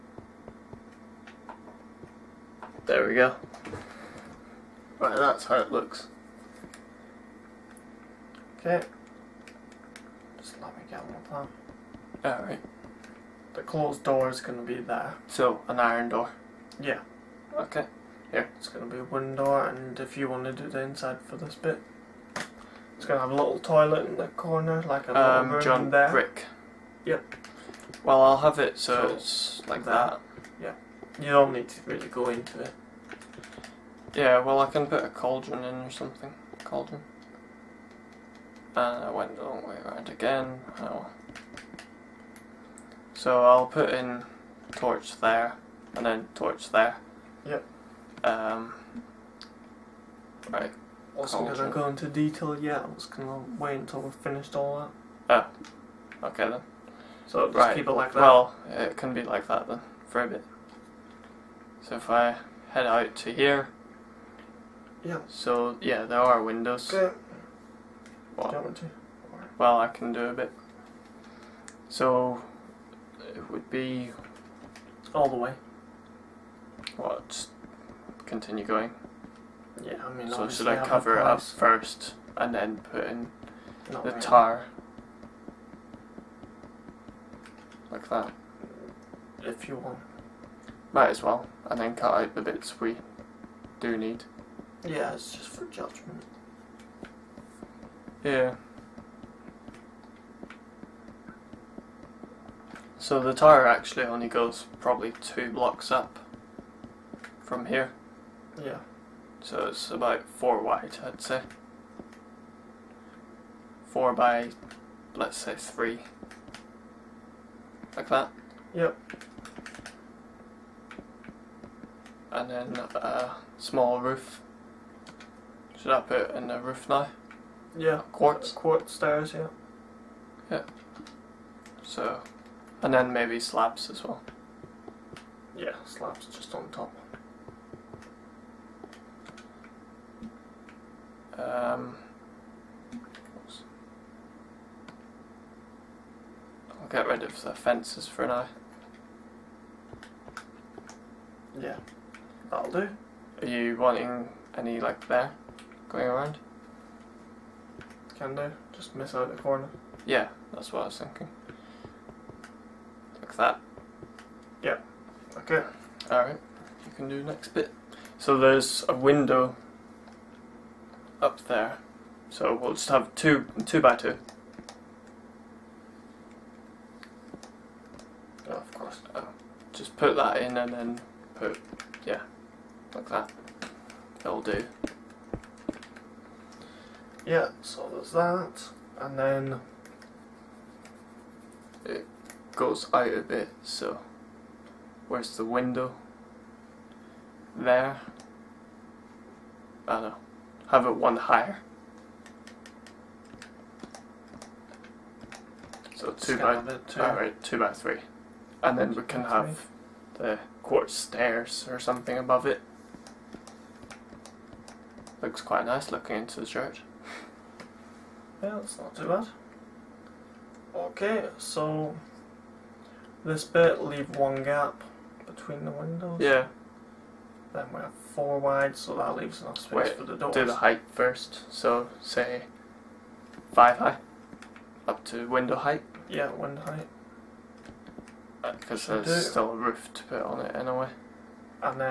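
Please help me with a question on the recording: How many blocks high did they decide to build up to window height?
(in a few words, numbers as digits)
5.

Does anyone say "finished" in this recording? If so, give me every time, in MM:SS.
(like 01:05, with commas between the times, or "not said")
00:54.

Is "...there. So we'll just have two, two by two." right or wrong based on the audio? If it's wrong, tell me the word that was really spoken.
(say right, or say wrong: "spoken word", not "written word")
right.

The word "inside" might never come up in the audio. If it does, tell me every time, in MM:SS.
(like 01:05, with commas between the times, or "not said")
00:20.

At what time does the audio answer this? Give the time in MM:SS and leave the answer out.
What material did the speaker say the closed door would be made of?
00:15.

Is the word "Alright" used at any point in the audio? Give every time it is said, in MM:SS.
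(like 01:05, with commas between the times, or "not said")
00:12, 02:46.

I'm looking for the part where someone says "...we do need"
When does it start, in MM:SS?
01:32.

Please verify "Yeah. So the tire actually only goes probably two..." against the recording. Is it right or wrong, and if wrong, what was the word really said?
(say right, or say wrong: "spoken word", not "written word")
right.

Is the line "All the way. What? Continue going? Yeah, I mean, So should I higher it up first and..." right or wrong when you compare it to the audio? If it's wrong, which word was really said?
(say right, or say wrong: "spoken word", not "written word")
wrong: "cover", not "higher".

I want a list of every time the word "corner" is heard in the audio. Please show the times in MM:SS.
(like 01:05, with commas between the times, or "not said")
00:24, 02:39.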